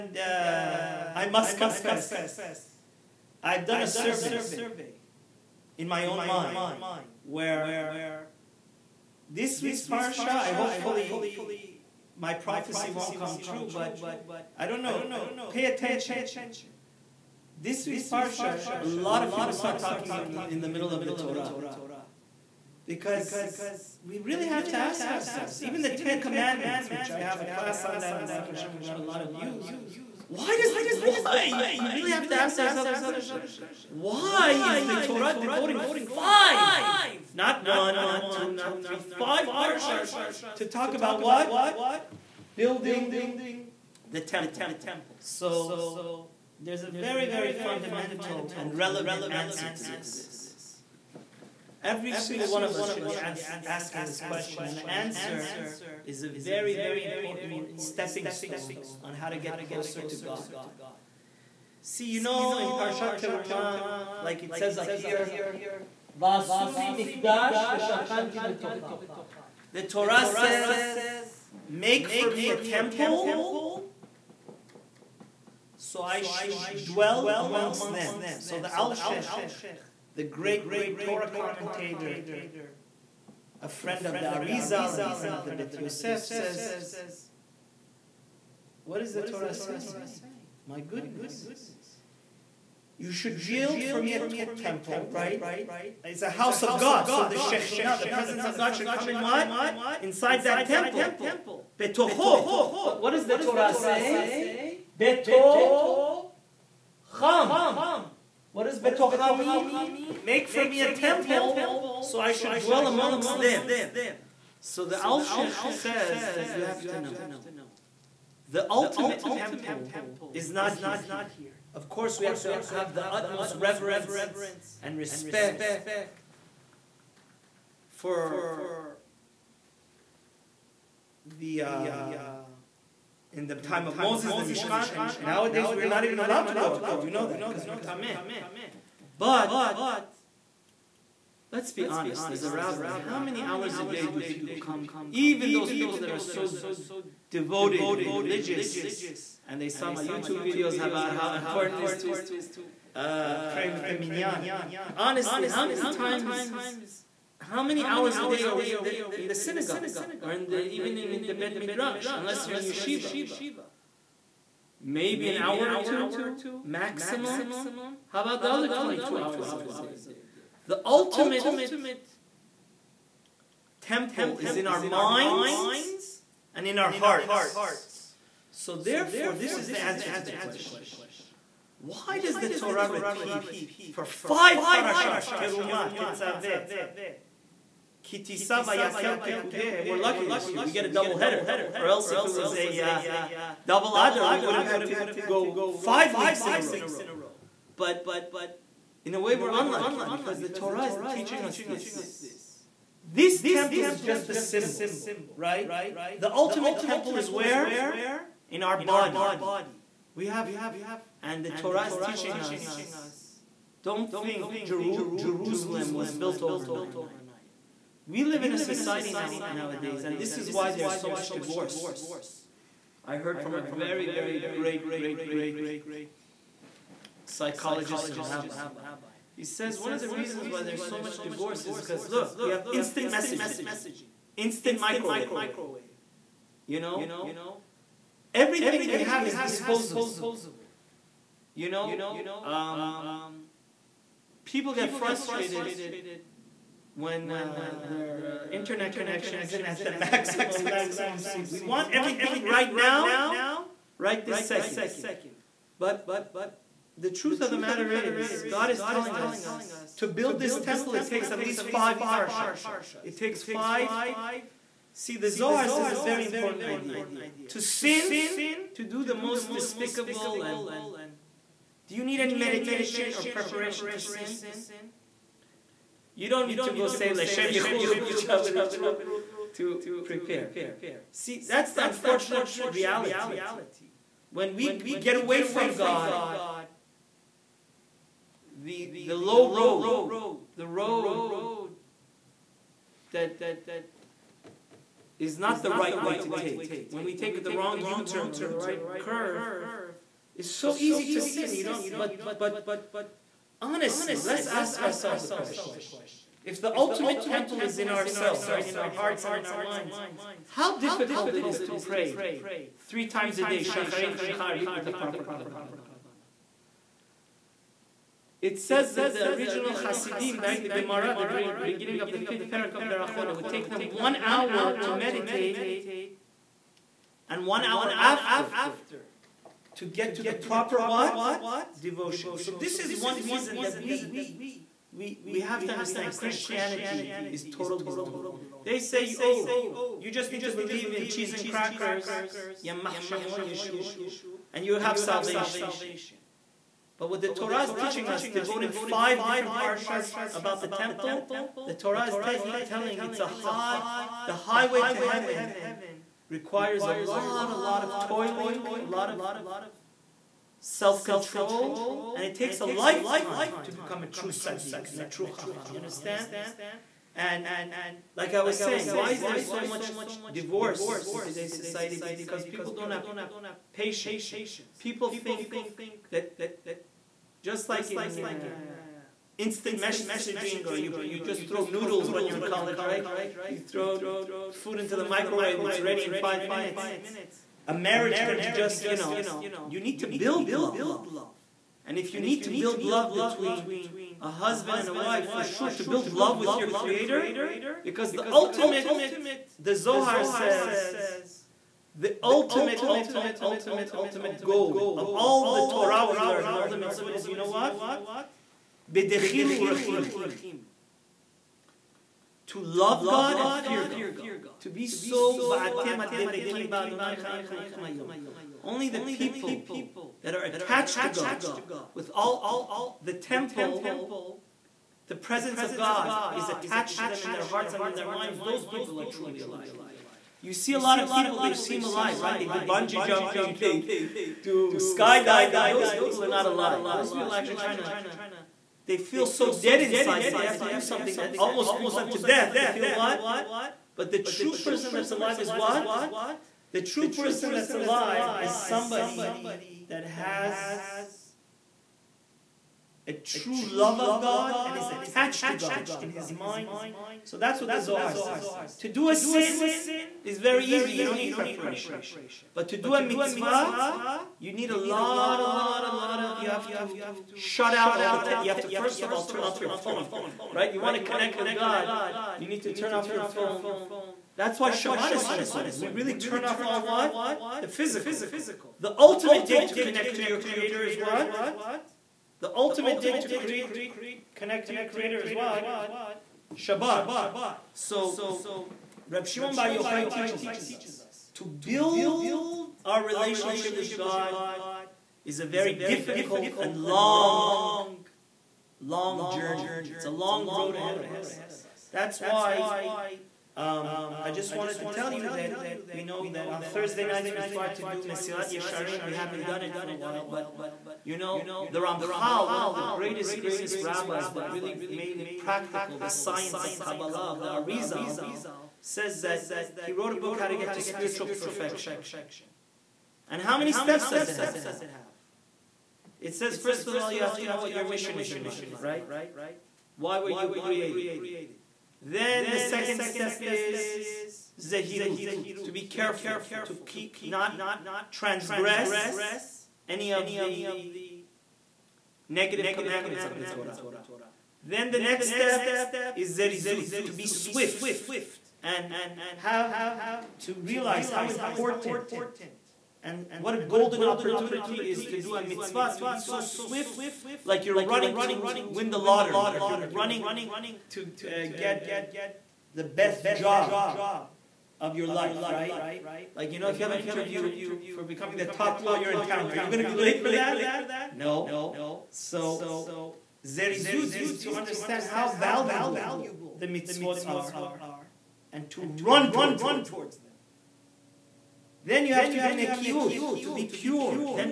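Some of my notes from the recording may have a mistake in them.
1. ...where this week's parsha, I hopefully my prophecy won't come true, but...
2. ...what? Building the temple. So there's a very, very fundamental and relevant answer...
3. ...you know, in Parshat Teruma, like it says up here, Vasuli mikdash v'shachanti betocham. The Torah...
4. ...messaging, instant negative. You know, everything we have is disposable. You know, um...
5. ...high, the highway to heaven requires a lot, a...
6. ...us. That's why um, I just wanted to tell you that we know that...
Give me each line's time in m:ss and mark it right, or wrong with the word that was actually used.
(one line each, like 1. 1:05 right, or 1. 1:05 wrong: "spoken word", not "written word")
1. 0:07 right
2. 0:41 right
3. 1:02 right
4. 3:53 wrong: "microwave", not "negative"
5. 5:53 right
6. 8:21 right.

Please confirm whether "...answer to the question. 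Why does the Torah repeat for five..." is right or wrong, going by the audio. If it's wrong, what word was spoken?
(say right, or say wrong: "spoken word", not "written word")
right.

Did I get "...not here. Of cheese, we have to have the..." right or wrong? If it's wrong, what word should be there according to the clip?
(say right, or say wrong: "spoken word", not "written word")
wrong: "course", not "cheese".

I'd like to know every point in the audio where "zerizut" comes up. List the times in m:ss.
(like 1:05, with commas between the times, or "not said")
9:06, 9:33.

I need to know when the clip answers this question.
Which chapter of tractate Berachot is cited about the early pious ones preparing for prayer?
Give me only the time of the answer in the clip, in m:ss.
5:22.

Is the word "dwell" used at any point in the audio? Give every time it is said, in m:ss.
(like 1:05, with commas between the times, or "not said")
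1:16, 1:52.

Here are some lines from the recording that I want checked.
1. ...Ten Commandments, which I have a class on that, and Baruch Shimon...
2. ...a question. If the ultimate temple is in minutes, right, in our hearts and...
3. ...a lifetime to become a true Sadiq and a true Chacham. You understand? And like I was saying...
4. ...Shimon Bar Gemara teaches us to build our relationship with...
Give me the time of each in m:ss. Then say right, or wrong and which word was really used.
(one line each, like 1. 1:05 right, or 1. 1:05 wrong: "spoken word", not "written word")
1. 0:25 wrong: "Hashem", not "Shimon"
2. 5:05 wrong: "ourselves", not "minutes"
3. 6:02 right
4. 8:09 wrong: "Yochai", not "Gemara".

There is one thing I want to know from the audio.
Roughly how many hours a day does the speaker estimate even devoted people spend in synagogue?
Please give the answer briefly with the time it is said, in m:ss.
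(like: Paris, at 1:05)
1 or 2, at 2:45.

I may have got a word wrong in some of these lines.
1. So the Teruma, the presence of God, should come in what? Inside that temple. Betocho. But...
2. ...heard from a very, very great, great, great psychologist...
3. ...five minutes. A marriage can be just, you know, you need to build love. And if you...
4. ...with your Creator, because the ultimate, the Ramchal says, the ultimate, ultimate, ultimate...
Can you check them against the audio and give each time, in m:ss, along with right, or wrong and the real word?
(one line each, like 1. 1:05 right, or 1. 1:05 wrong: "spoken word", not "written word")
1. 1:37 wrong: "Shekhinah", not "Teruma"
2. 3:43 right
3. 6:26 right
4. 6:36 wrong: "Zohar", not "Ramchal".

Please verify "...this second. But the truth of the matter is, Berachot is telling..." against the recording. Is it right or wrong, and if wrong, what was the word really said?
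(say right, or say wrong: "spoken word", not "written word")
wrong: "God", not "Berachot".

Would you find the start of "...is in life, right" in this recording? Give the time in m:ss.
8:48.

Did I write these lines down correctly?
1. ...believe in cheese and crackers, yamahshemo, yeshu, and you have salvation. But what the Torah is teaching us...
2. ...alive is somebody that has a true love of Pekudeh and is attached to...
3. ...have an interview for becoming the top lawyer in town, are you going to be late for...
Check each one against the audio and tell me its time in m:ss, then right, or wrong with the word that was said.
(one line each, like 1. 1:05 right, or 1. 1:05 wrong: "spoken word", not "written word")
1. 5:40 right
2. 7:27 wrong: "God", not "Pekudeh"
3. 9:26 right.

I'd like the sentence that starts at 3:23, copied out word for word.
This temple is just a symbol, right?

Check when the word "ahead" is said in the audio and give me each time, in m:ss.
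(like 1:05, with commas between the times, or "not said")
8:20.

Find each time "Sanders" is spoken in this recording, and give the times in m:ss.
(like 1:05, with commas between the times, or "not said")
not said.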